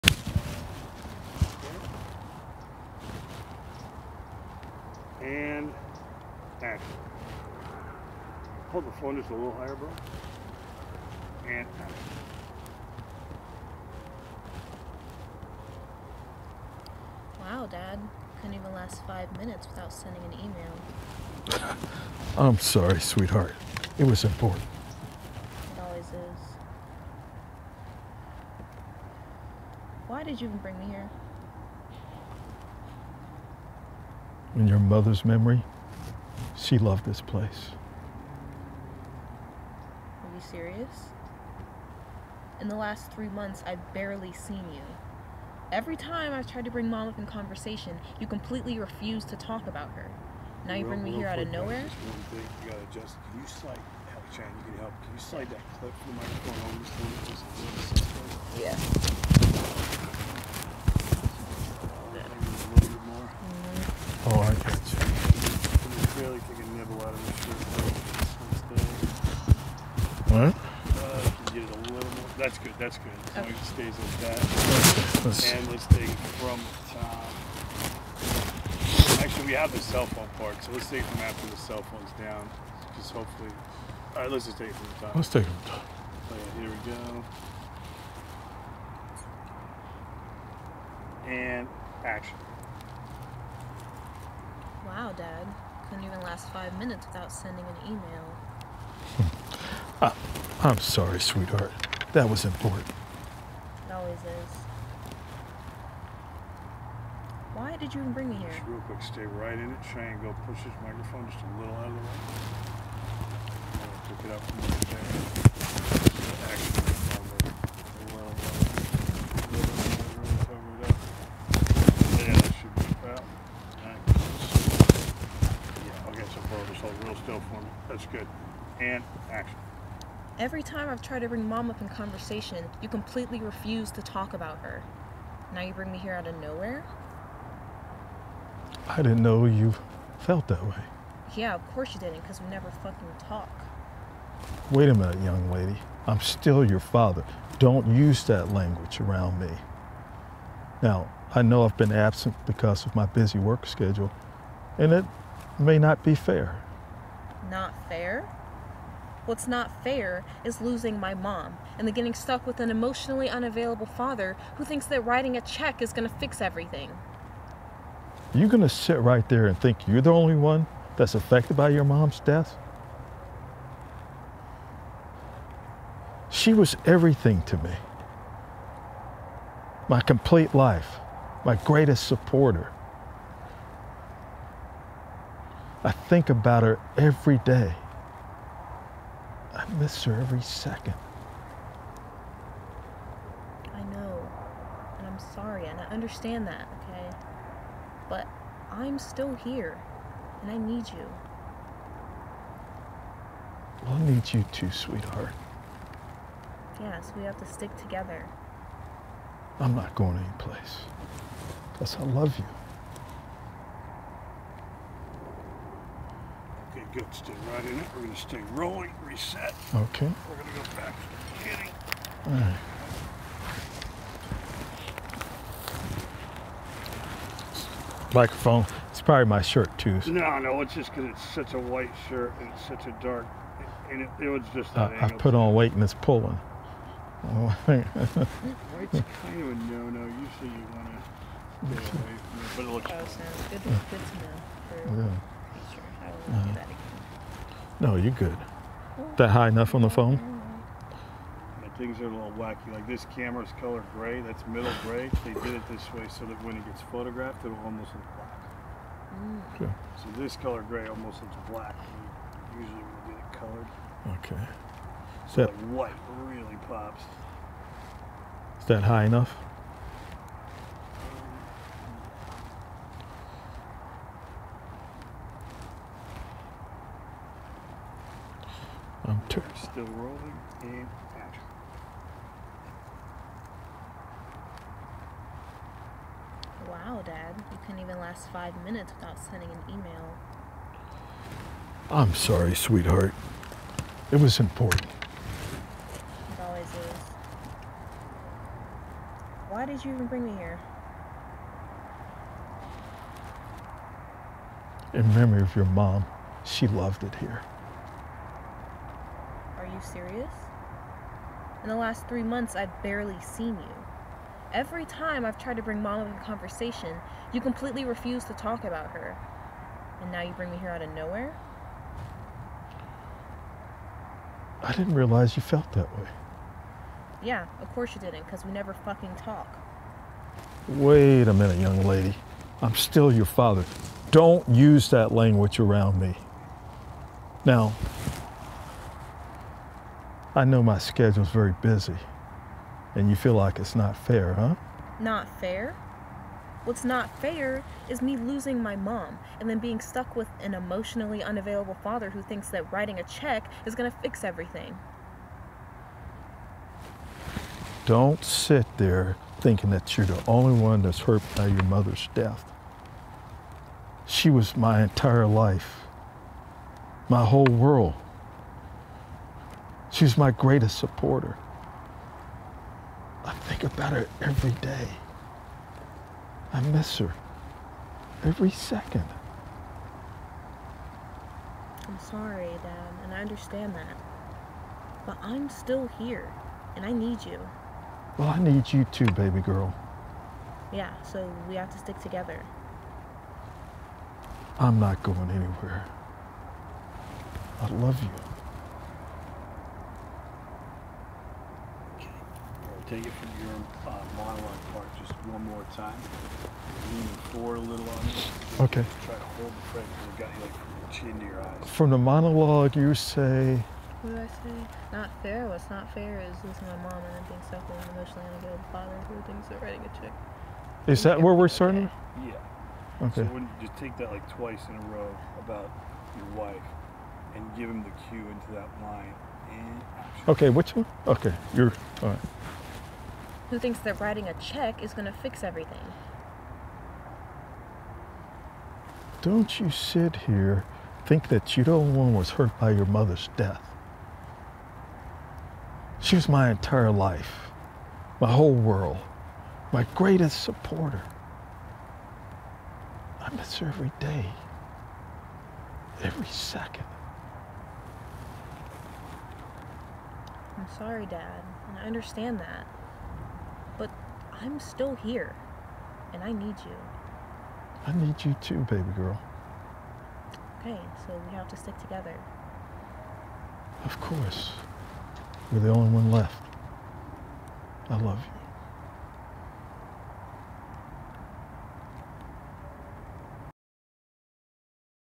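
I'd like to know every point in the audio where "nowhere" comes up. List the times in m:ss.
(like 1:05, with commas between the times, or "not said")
0:51, 2:16, 5:20.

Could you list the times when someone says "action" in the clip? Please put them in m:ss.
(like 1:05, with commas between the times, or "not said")
1:32, 2:09, 4:41.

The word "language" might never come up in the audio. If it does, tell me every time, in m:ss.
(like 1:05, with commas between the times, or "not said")
2:28, 5:35.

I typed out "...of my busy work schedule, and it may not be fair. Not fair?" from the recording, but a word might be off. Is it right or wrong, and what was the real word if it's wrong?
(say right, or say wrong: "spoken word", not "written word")
right.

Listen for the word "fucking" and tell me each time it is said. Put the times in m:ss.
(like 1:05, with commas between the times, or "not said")
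2:22, 5:28.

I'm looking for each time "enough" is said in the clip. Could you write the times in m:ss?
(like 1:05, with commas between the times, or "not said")
4:09, 4:29.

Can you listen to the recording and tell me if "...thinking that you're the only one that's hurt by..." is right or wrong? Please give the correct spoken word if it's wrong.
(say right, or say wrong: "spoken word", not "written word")
right.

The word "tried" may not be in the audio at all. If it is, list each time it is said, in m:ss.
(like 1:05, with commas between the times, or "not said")
0:46, 2:11, 5:15.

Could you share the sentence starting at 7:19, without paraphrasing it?
Don't you sit here, think that you don't one was hurt by your mother's death.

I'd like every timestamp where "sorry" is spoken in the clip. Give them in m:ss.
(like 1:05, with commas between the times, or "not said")
0:22, 1:40, 3:15, 4:52, 6:21, 7:40.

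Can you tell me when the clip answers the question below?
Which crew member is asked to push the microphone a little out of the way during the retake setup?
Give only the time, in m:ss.
1:49.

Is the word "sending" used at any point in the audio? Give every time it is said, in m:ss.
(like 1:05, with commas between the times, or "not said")
0:19, 1:37, 4:49.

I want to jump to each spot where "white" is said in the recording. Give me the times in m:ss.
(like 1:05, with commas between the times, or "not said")
3:51, 3:57, 4:25.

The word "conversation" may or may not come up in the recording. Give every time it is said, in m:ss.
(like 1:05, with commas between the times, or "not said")
0:47, 2:11, 5:16.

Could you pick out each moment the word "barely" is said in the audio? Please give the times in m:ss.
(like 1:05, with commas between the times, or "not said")
0:43, 5:12.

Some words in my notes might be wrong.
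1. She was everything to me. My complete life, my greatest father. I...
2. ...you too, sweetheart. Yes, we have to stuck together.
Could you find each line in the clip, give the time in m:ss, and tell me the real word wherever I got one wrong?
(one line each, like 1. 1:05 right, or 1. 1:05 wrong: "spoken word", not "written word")
1. 2:56 wrong: "supporter", not "father"
2. 3:24 wrong: "stick", not "stuck".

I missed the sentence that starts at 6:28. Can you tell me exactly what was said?
Well, I need you too, baby girl.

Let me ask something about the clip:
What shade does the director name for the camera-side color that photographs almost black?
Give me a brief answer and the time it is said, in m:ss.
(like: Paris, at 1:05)
Middle gray, at 4:14.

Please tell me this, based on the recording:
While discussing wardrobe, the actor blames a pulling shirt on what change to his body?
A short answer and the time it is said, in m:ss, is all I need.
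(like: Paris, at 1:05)
Put on weight, at 3:55.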